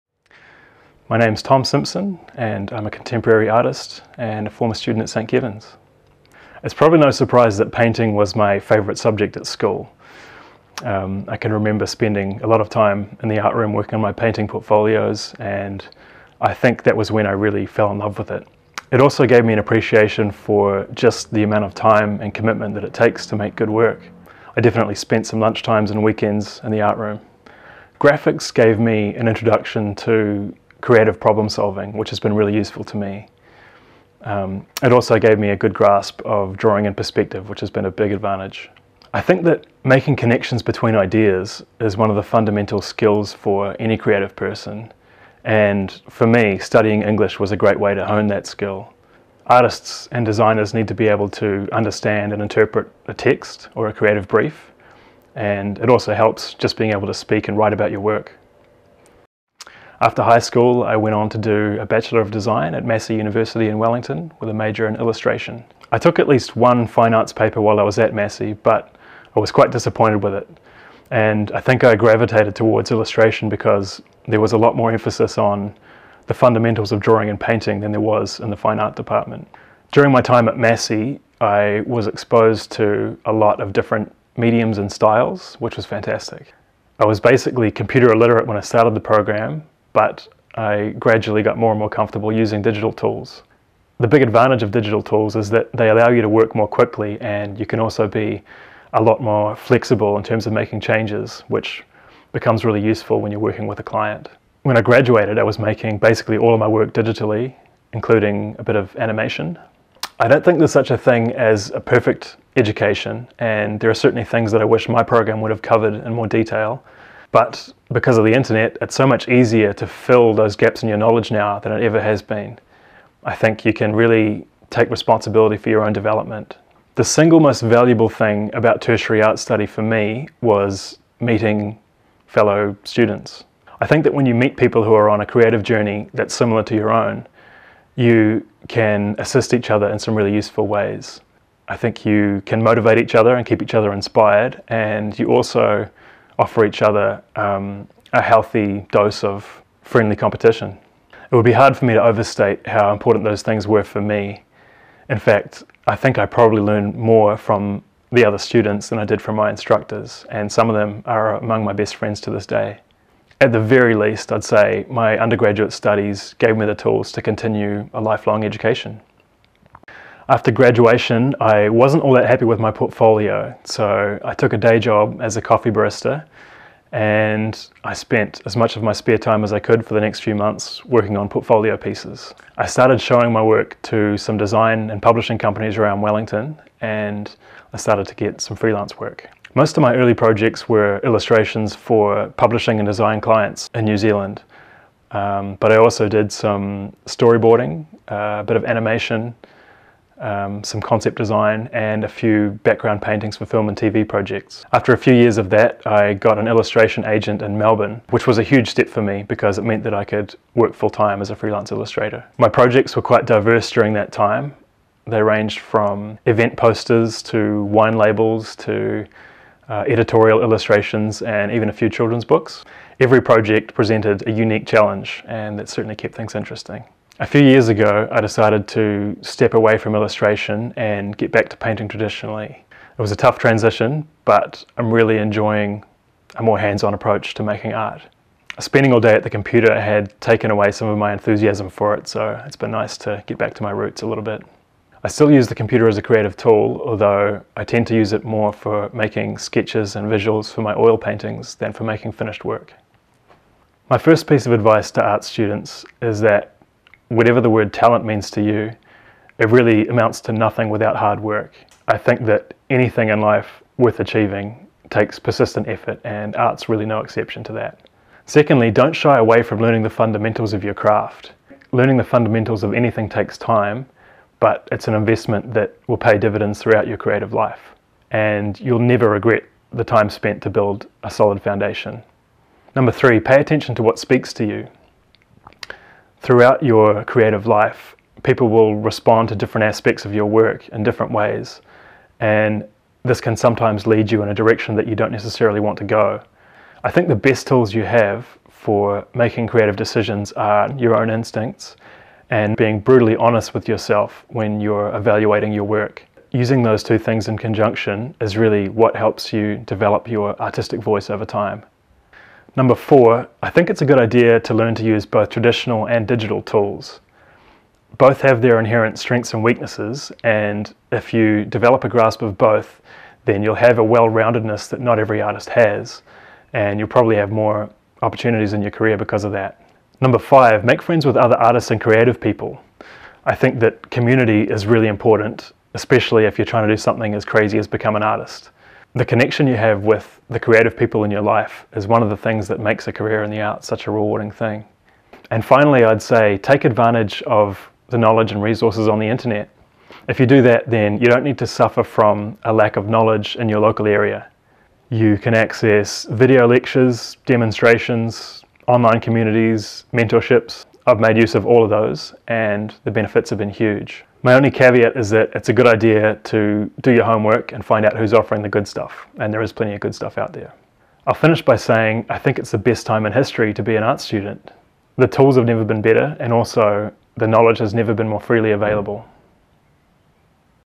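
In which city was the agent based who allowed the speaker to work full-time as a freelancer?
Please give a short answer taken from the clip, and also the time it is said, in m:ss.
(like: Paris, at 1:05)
Melbourne, at 3:27.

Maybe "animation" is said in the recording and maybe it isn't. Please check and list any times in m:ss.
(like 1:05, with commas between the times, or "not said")
1:48, 3:18.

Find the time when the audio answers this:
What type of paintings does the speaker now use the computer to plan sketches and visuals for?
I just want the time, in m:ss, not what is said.
4:10.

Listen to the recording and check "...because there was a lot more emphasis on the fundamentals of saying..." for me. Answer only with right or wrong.
wrong.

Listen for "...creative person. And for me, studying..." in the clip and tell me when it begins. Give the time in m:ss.
0:43.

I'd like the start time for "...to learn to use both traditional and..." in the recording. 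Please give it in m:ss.
5:14.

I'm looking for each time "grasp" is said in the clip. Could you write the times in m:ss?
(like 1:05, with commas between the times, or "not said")
0:35, 5:21.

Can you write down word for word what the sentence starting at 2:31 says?
It would be hard for me to overstate how important those things were for me.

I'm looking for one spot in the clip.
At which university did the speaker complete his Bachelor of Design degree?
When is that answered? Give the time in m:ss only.
1:02.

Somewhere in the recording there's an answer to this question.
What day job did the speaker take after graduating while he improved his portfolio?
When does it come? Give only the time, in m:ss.
2:55.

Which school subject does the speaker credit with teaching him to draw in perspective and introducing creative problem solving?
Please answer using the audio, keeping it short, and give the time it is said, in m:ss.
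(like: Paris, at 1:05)
Graphics, at 0:27.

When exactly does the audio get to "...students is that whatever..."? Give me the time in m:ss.
4:15.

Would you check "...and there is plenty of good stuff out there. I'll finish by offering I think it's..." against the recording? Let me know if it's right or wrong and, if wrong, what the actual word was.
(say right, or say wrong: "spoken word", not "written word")
wrong: "saying", not "offering".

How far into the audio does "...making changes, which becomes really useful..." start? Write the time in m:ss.
1:40.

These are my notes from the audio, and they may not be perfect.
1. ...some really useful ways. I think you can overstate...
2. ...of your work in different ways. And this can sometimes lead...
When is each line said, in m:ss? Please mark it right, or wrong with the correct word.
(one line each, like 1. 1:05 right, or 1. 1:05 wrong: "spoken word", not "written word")
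1. 2:19 wrong: "motivate", not "overstate"
2. 4:50 right.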